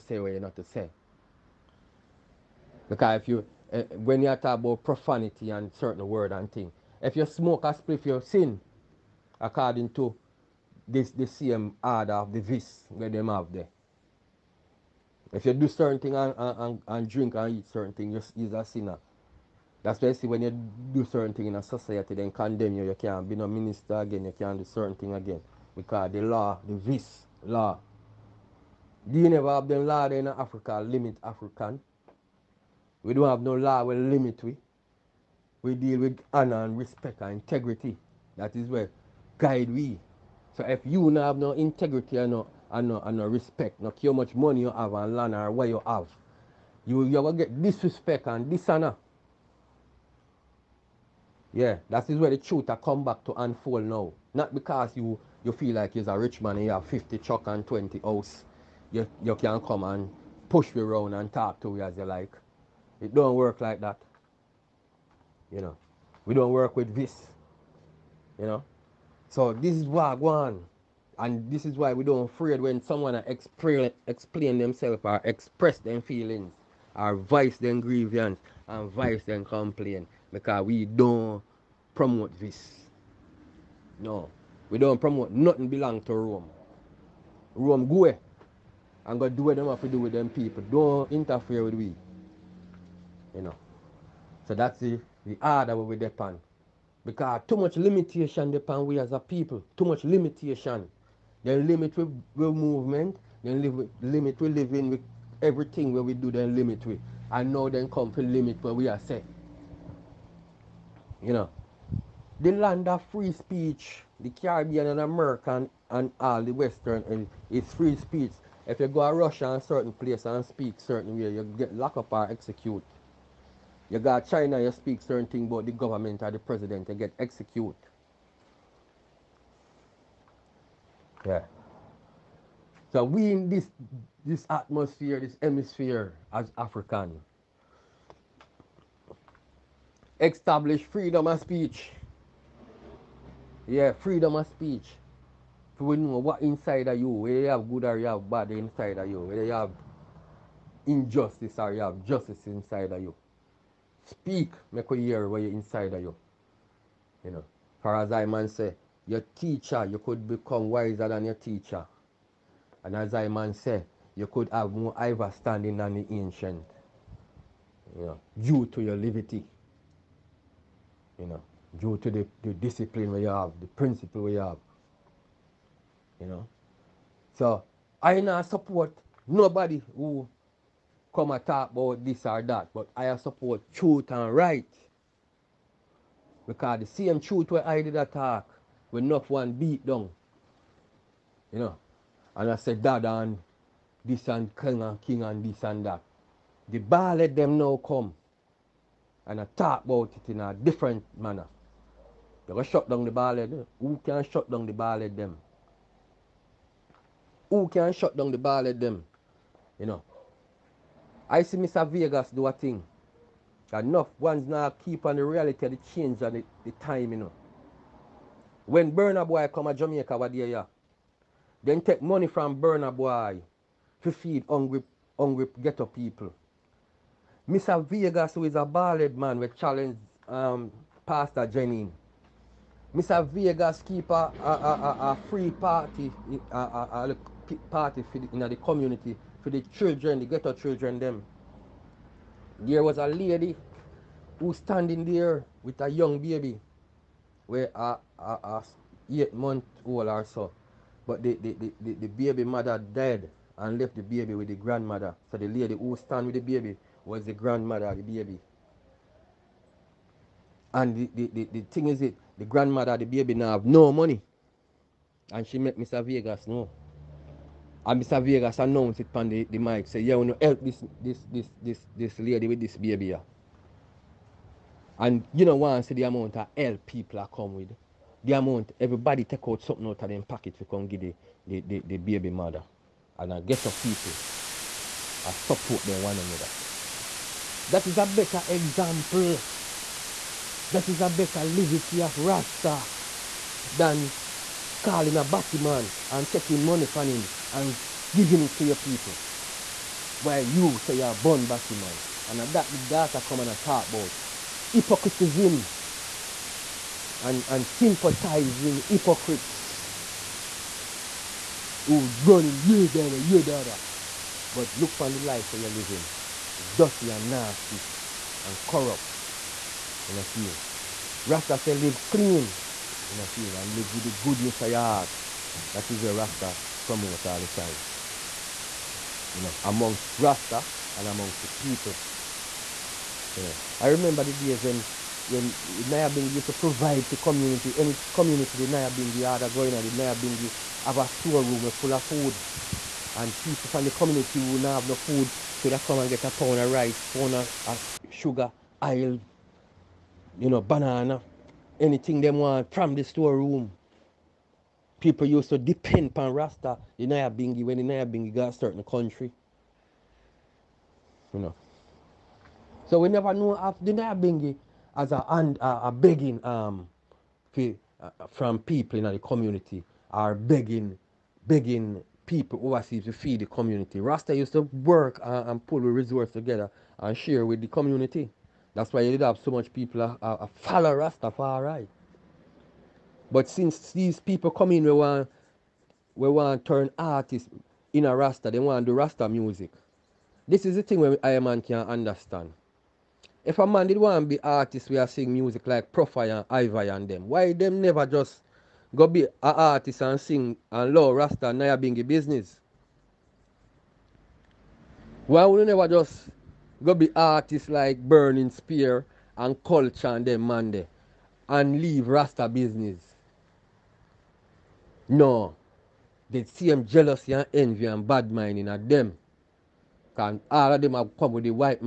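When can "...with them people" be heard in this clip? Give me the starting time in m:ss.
1:29.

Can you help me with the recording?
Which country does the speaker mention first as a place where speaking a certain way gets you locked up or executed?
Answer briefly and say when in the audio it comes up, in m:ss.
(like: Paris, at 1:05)
Russia, at 1:59.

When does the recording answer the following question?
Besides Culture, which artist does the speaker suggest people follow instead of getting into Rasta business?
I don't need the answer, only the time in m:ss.
6:47.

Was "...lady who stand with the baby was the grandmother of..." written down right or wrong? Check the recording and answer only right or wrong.
right.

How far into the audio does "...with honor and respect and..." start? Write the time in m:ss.
0:36.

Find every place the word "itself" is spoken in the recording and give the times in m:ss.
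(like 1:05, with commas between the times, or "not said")
not said.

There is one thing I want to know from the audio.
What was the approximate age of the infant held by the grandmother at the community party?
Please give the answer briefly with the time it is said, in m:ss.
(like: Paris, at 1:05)
8 months, at 4:09.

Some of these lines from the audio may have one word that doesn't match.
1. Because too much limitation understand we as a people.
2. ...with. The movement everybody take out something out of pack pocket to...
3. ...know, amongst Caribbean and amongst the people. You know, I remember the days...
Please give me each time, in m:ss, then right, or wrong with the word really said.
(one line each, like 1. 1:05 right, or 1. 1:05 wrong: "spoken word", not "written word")
1. 1:37 wrong: "depend", not "understand"
2. 4:37 wrong: "amount", not "movement"
3. 5:29 wrong: "Rasta", not "Caribbean".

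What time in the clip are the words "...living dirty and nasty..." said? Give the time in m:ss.
5:15.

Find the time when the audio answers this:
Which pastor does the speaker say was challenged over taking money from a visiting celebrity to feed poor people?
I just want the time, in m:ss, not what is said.
3:51.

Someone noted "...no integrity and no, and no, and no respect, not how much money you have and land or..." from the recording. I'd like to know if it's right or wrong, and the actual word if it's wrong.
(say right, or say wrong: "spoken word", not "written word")
right.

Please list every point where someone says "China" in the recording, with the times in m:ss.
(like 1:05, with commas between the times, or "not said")
2:04.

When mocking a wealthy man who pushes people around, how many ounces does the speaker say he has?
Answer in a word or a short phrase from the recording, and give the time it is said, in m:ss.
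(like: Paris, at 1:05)
20 ounce, at 0:57.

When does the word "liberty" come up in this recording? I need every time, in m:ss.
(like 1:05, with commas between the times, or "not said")
2:48, 4:51.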